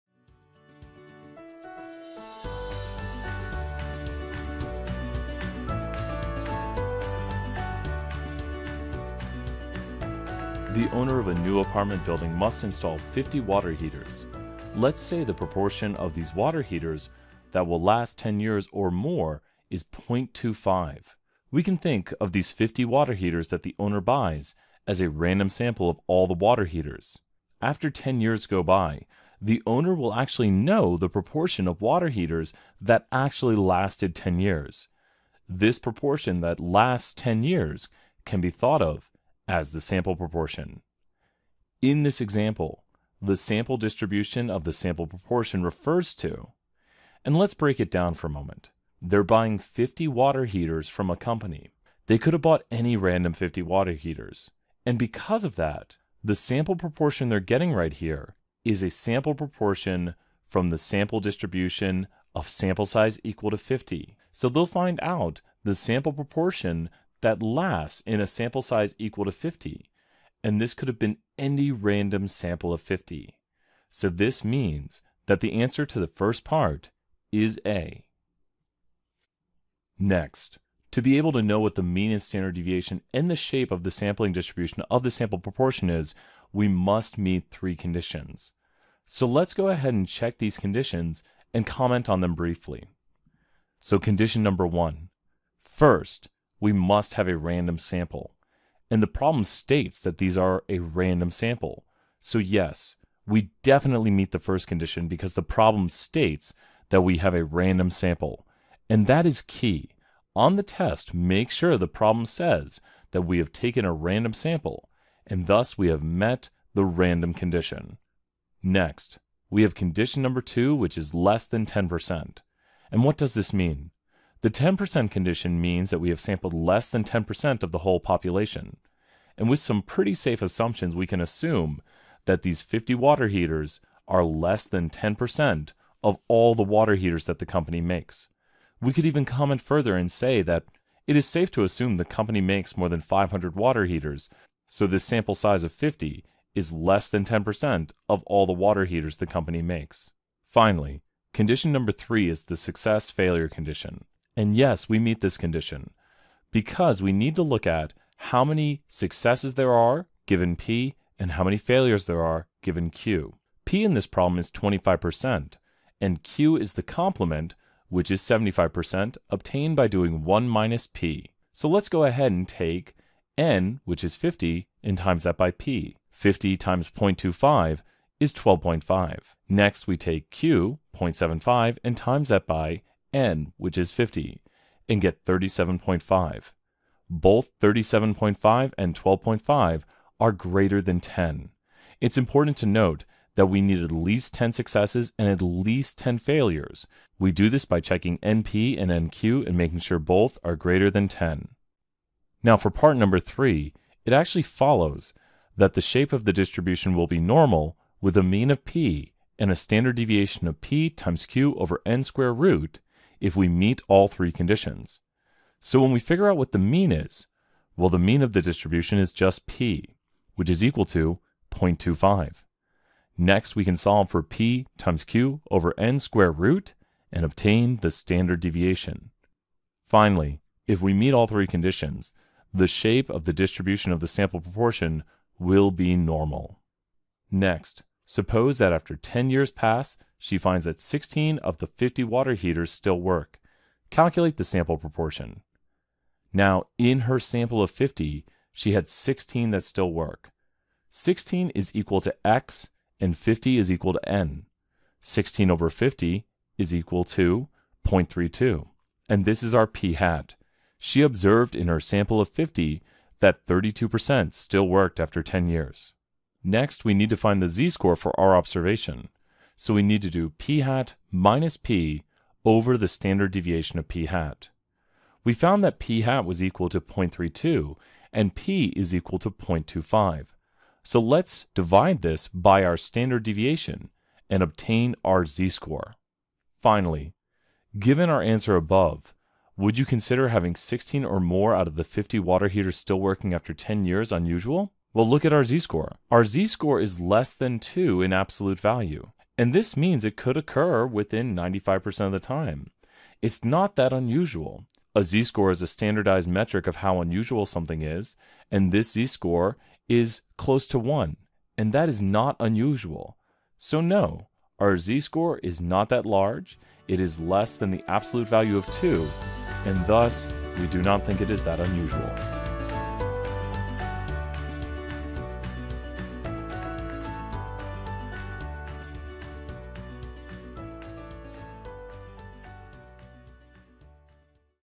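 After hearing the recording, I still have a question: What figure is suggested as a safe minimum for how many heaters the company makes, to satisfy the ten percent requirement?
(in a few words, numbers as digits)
500.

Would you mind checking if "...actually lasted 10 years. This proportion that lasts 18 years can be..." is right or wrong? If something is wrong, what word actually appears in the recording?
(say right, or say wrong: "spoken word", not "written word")
wrong: "10", not "18".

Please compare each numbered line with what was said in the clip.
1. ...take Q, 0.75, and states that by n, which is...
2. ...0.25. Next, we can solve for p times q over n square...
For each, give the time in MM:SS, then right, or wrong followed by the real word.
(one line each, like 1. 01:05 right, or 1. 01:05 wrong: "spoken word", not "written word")
1. 02:59 wrong: "times", not "states"
2. 03:41 right.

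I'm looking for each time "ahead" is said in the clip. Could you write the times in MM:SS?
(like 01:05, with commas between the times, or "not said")
01:29, 02:52.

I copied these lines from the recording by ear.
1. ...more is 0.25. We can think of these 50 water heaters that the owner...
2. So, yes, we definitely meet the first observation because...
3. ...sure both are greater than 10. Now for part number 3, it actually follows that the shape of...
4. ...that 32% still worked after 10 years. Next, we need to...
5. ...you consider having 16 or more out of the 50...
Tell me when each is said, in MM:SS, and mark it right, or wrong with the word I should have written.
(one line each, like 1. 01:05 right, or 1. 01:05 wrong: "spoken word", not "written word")
1. 00:18 right
2. 01:42 wrong: "condition", not "observation"
3. 03:19 right
4. 04:23 right
5. 04:49 right.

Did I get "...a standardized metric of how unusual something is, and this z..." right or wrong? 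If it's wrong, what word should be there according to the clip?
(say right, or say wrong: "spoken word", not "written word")
right.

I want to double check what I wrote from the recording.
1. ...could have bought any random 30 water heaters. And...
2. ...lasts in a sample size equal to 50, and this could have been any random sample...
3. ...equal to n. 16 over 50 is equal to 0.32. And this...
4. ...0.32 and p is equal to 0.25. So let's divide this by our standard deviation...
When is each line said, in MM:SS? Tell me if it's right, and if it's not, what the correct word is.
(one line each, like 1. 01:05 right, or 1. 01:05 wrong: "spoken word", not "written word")
1. 00:52 wrong: "50", not "30"
2. 01:07 right
3. 04:13 right
4. 04:36 right.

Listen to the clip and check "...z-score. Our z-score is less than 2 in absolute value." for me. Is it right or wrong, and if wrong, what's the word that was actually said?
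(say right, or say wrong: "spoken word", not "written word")
right.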